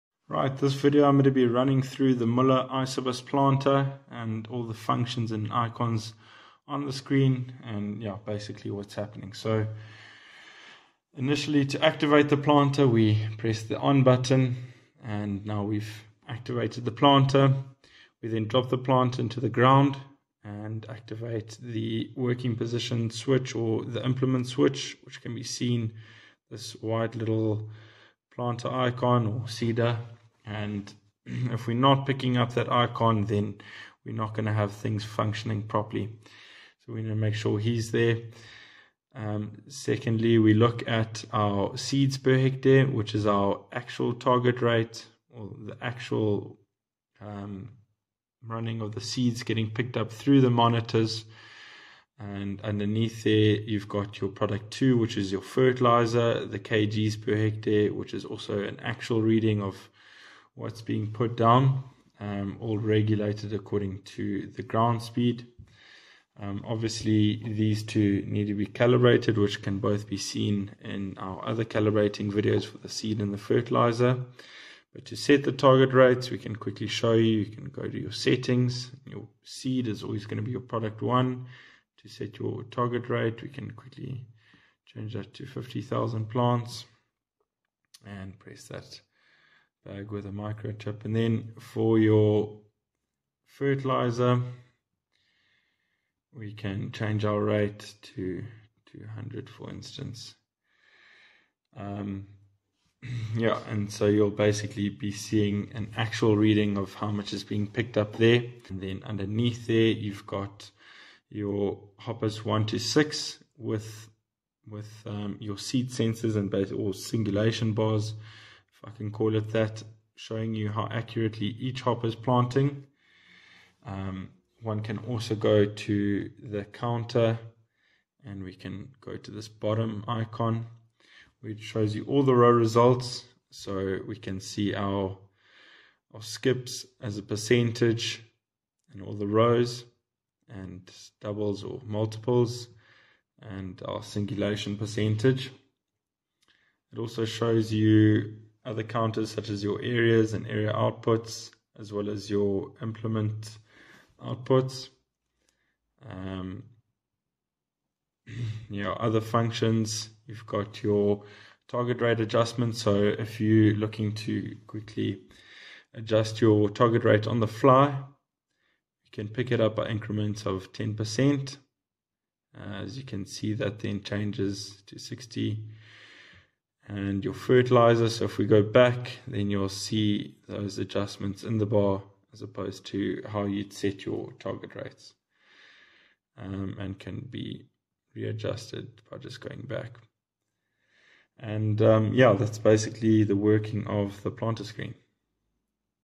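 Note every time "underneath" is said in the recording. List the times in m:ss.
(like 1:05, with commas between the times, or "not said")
0:52, 1:49.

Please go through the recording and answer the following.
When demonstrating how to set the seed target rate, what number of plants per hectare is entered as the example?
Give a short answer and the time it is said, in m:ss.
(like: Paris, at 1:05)
50,000, at 1:25.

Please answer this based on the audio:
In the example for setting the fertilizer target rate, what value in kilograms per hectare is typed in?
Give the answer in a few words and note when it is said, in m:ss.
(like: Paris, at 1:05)
200, at 1:38.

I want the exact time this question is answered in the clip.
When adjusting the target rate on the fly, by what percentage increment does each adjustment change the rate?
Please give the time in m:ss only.
2:50.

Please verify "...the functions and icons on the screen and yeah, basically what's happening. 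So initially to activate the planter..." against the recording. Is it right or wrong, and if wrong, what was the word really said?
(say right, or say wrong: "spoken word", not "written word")
right.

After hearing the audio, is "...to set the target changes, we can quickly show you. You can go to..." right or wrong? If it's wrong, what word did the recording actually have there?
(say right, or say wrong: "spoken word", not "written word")
wrong: "rates", not "changes".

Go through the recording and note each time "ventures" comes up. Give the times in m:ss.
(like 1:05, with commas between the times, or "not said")
not said.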